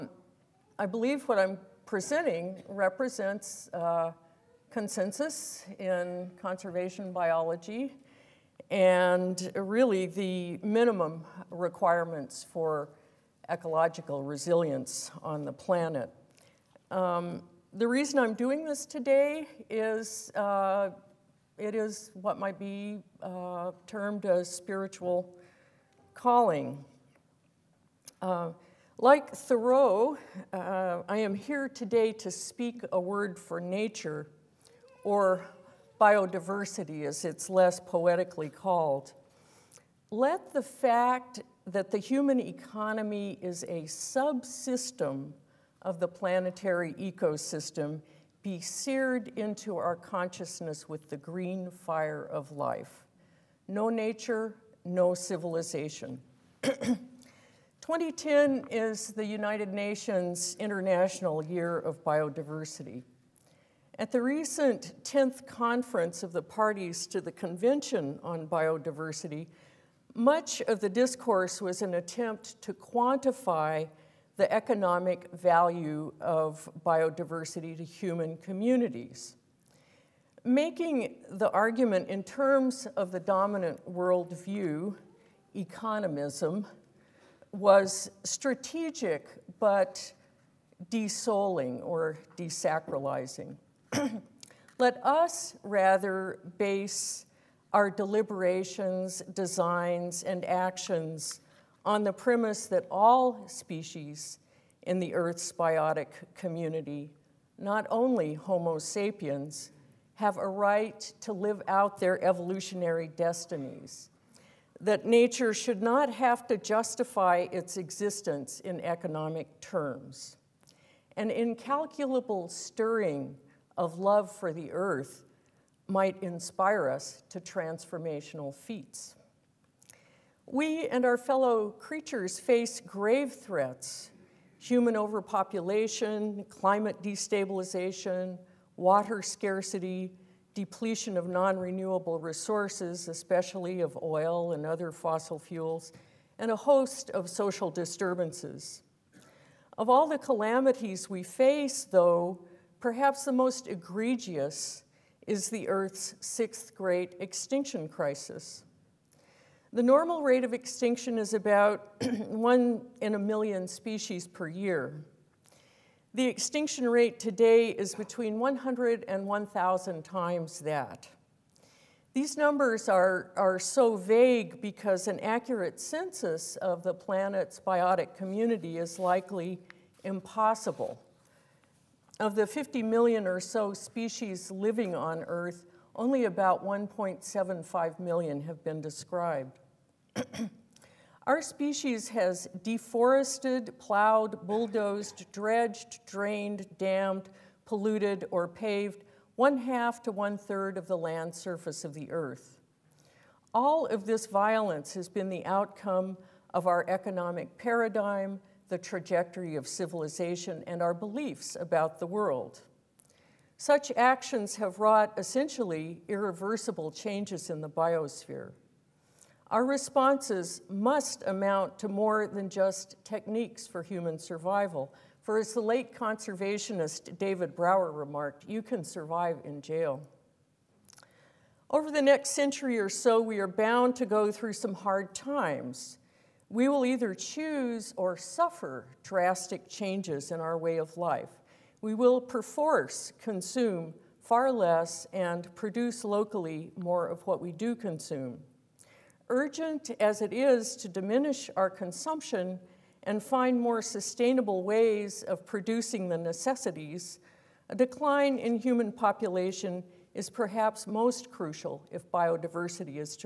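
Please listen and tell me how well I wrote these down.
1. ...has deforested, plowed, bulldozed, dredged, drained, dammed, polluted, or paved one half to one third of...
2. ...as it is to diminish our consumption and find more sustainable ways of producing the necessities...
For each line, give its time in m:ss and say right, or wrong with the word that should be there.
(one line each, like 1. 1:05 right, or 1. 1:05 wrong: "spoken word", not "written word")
1. 3:12 right
2. 4:09 right.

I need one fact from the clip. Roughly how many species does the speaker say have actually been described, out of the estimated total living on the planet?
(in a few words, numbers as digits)
1.75 million.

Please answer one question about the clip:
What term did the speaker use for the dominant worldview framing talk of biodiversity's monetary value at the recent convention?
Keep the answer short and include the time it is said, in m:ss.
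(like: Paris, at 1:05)
economism, at 1:25.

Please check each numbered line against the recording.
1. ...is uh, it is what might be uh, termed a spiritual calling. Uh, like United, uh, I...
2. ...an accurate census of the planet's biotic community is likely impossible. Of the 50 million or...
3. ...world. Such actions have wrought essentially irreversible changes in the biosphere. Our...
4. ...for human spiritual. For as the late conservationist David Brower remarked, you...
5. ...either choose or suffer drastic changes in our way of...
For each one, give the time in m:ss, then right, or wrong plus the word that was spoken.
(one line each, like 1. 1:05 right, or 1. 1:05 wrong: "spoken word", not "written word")
1. 0:19 wrong: "Thoreau", not "United"
2. 2:55 right
3. 3:32 right
4. 3:43 wrong: "survival", not "spiritual"
5. 3:56 right.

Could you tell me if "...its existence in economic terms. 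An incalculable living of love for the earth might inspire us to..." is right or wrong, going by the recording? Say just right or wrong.
wrong.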